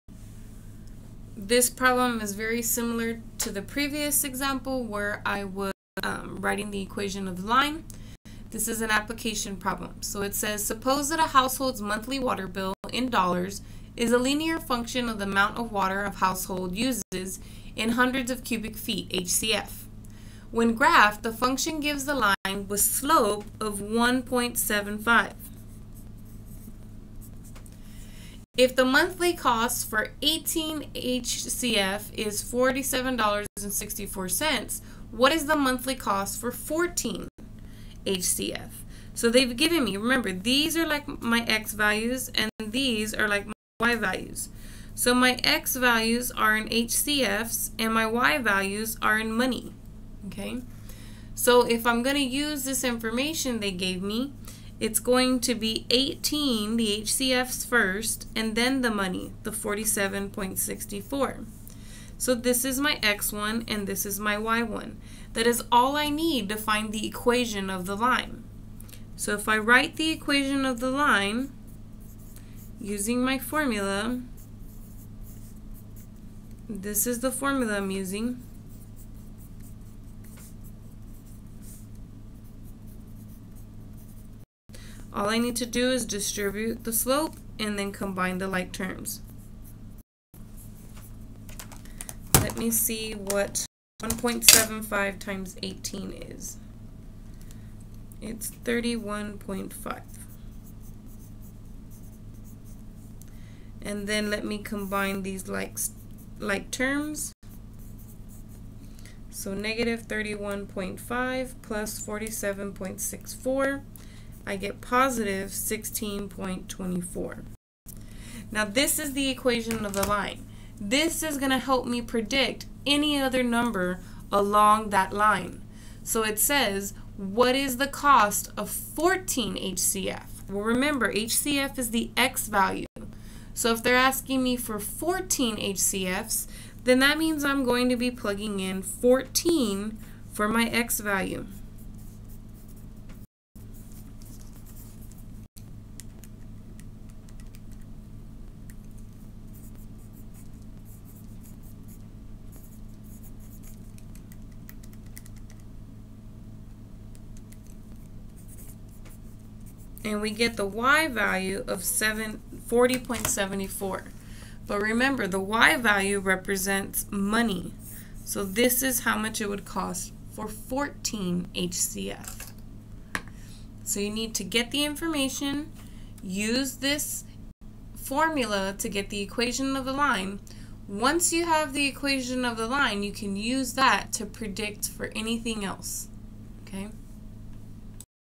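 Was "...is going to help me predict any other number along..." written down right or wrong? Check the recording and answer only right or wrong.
right.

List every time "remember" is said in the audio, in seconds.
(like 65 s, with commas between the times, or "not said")
39 s, 130 s, 164 s.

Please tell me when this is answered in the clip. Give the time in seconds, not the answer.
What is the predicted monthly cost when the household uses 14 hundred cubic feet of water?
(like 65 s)
161 s.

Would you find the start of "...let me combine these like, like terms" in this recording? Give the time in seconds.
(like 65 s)
104 s.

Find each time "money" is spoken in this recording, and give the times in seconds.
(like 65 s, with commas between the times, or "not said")
49 s, 58 s, 167 s.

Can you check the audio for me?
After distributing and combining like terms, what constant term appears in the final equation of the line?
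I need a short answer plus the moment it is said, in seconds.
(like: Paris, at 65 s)
16.24, at 114 s.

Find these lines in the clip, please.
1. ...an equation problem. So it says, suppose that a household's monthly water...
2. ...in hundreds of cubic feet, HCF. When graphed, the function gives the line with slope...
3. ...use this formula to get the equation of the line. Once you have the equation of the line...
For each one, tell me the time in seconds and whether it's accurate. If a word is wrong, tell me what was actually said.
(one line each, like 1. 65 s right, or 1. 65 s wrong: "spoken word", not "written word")
1. 8 s wrong: "application", not "equation"
2. 17 s right
3. 176 s right.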